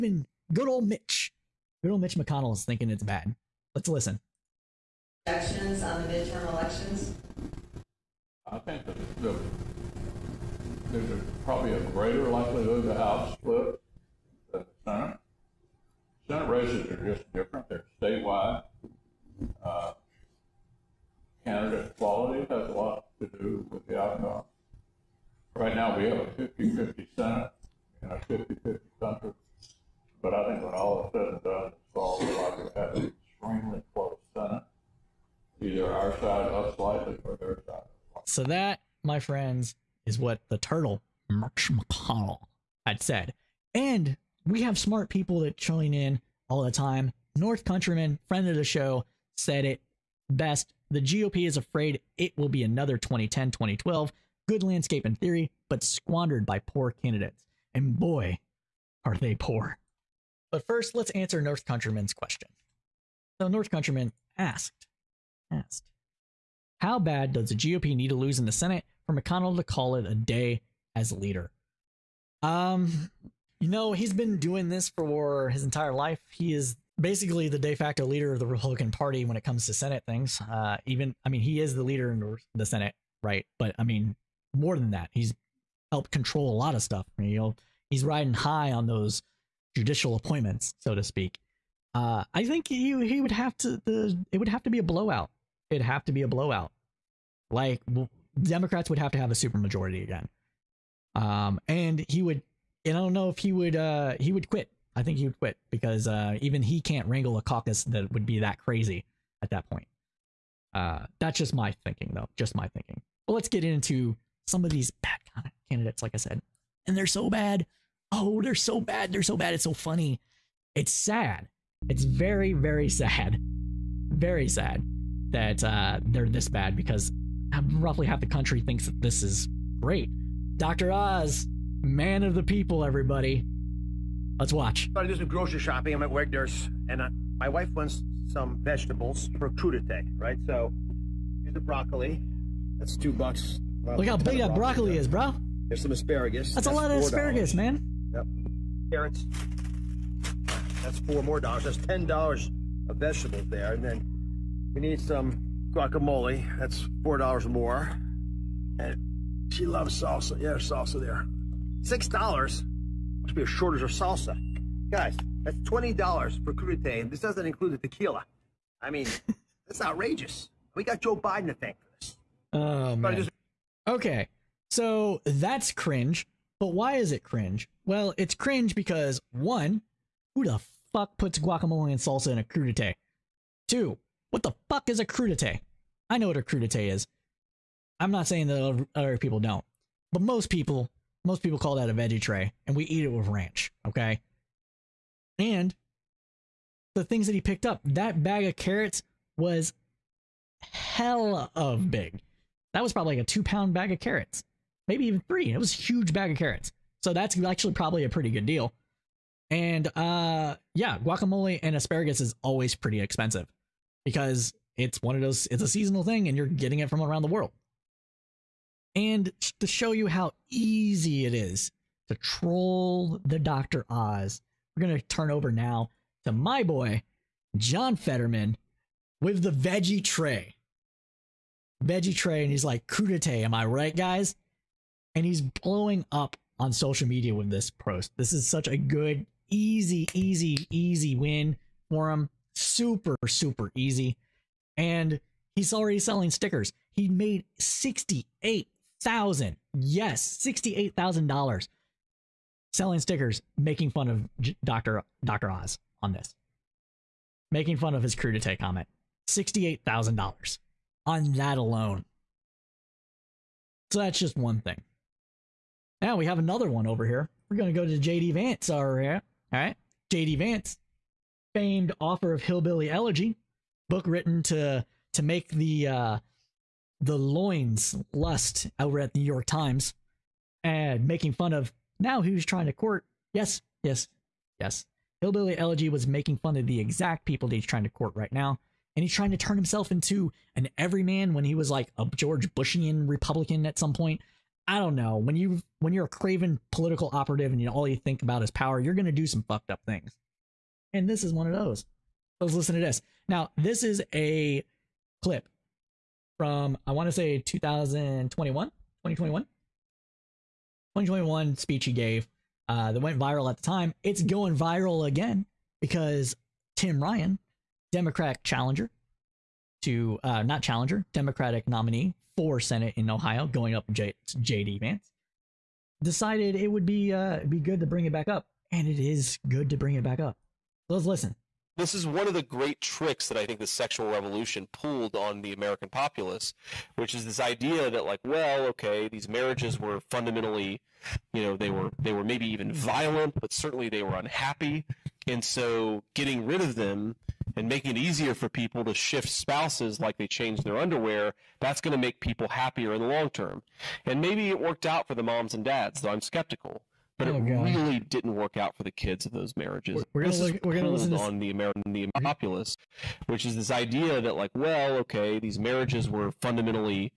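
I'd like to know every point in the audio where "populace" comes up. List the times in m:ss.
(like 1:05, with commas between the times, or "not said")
5:35, 6:02.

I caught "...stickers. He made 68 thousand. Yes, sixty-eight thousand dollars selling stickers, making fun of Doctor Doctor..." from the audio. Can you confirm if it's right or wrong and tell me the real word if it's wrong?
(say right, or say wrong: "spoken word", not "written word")
right.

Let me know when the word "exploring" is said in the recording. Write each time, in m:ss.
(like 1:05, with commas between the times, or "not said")
not said.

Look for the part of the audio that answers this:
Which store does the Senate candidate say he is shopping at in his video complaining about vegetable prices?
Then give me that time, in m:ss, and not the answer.
2:16.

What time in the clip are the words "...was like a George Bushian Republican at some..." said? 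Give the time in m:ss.
4:51.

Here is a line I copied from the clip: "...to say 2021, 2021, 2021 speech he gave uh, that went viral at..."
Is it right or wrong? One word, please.
right.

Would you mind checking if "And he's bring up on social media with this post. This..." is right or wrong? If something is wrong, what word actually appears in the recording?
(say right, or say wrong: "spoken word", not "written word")
wrong: "blowing", not "bring".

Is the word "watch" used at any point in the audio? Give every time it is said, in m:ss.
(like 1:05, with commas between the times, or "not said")
2:14.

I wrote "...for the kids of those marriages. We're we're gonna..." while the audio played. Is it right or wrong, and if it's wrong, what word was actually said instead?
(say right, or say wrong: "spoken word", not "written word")
right.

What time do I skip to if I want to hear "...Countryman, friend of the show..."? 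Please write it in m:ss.
0:47.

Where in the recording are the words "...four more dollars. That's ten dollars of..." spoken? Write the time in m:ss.
2:30.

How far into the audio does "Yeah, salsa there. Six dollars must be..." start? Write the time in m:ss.
2:40.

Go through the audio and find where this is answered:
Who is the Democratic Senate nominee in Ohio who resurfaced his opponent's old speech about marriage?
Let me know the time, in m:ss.
5:16.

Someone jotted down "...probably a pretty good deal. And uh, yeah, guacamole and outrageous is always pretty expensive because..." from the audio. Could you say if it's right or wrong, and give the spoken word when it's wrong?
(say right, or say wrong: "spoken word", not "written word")
wrong: "asparagus", not "outrageous".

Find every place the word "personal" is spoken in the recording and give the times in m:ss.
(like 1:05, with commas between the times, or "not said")
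not said.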